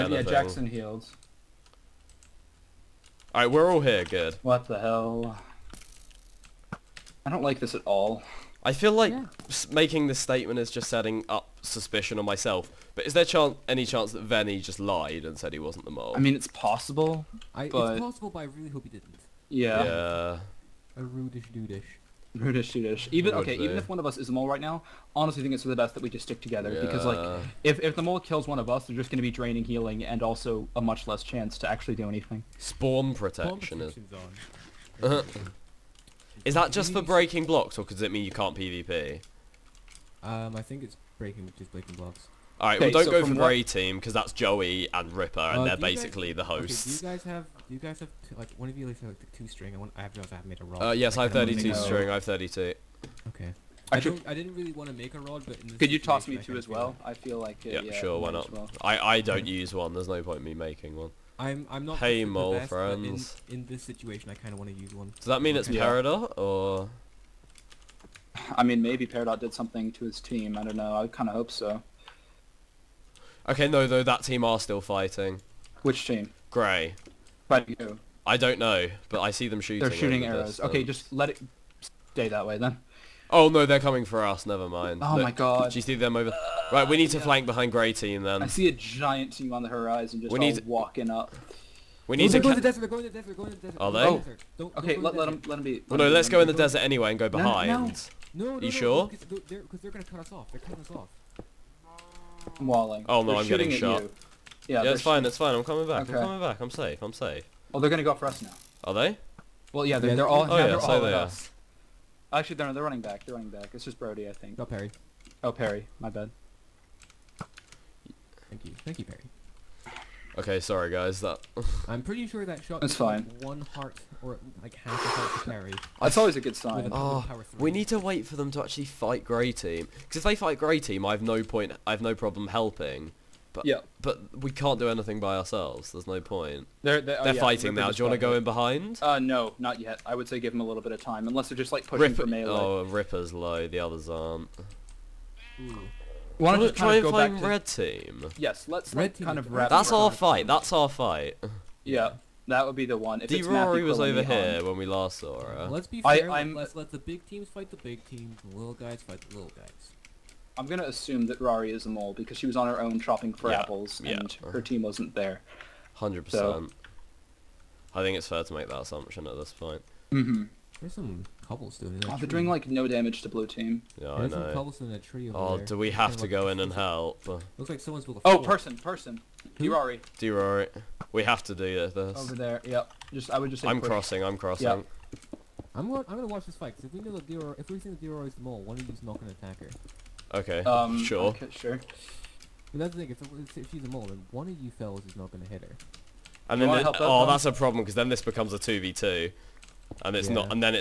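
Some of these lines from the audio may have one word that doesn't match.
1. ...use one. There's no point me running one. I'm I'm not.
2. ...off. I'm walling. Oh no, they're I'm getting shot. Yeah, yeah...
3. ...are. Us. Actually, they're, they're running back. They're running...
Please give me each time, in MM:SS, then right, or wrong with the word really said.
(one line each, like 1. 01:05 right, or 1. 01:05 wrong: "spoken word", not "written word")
1. 00:59 wrong: "making", not "running"
2. 01:40 right
3. 01:51 right.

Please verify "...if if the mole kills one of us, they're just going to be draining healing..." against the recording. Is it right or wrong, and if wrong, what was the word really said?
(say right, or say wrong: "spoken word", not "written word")
right.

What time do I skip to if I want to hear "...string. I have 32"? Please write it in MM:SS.
00:51.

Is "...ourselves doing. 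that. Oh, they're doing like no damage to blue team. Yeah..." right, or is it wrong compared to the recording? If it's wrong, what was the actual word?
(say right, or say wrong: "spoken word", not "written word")
wrong: "cobbles", not "ourselves".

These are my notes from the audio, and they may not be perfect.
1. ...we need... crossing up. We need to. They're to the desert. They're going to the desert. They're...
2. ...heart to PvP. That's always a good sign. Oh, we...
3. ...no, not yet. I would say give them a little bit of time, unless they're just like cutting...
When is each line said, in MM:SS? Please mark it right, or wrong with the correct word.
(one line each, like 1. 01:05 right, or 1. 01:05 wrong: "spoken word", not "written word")
1. 01:30 wrong: "walking", not "crossing"
2. 02:05 wrong: "Perry", not "PvP"
3. 02:19 wrong: "pushing", not "cutting".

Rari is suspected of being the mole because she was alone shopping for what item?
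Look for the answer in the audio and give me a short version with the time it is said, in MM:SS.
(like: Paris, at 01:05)
apples, at 02:43.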